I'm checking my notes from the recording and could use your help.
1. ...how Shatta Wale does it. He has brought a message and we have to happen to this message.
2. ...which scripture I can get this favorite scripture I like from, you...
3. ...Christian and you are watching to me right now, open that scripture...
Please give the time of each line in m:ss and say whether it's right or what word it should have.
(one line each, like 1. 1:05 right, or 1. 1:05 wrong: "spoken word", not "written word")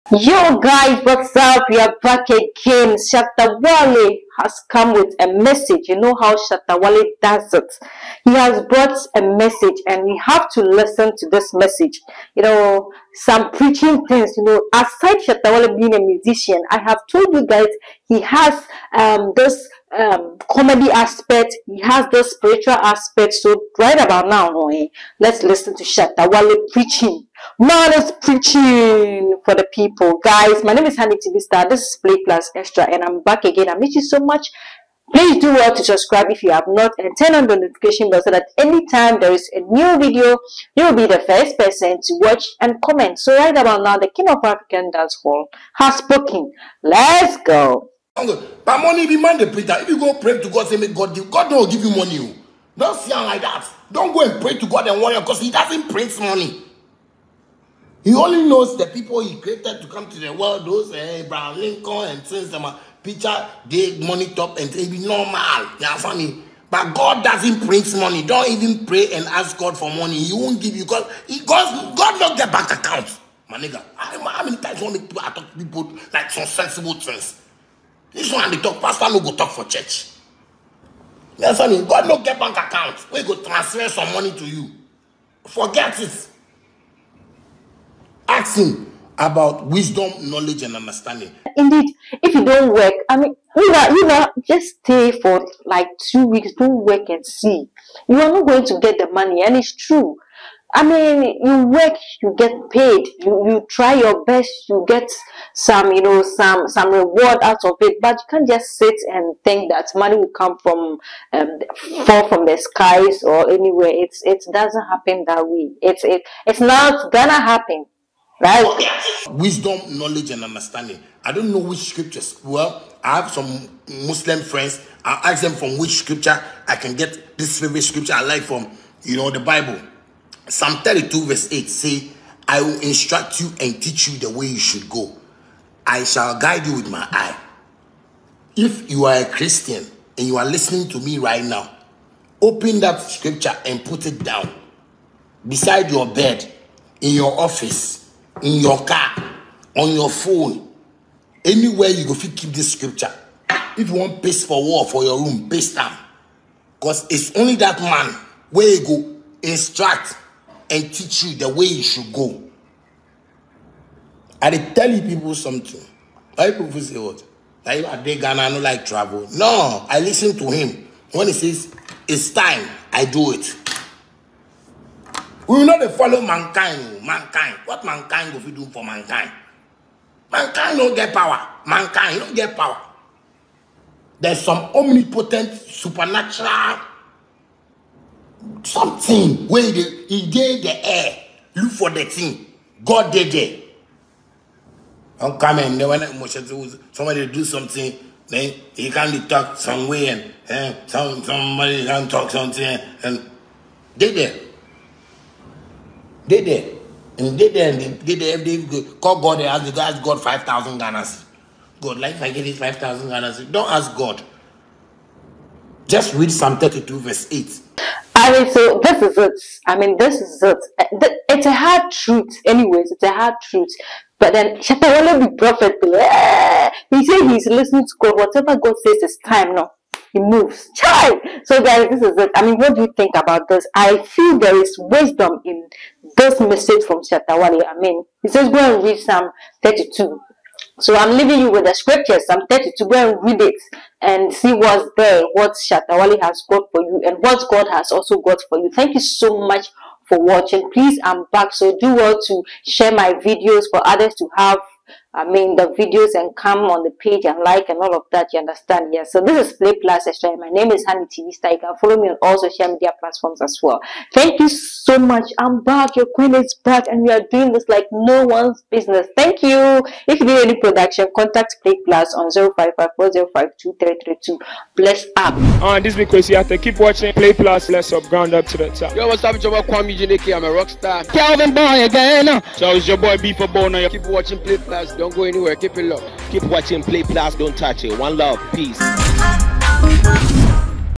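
1. 0:06 wrong: "listen", not "happen"
2. 2:05 right
3. 2:19 wrong: "listening", not "watching".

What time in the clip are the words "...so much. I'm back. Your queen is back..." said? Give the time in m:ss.
4:24.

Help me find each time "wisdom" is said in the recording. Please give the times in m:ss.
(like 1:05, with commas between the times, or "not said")
1:29, 1:59, 3:54.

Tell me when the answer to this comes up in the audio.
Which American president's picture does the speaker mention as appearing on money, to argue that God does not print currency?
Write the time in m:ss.
1:01.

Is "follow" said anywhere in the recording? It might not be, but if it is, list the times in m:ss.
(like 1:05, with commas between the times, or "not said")
2:55, 4:21.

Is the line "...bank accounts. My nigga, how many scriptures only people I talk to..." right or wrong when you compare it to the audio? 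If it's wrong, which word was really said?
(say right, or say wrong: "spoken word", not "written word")
wrong: "times", not "scriptures".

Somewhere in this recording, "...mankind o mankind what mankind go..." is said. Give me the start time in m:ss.
2:56.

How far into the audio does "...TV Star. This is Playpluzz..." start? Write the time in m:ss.
0:31.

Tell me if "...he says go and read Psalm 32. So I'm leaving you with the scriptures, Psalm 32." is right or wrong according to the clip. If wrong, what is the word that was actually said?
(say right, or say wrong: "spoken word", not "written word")
right.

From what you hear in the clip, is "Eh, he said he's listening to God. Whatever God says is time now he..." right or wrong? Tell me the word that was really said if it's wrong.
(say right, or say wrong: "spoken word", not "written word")
right.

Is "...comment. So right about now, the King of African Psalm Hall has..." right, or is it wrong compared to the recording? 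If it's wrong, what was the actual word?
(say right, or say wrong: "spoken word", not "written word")
wrong: "Dance", not "Psalm".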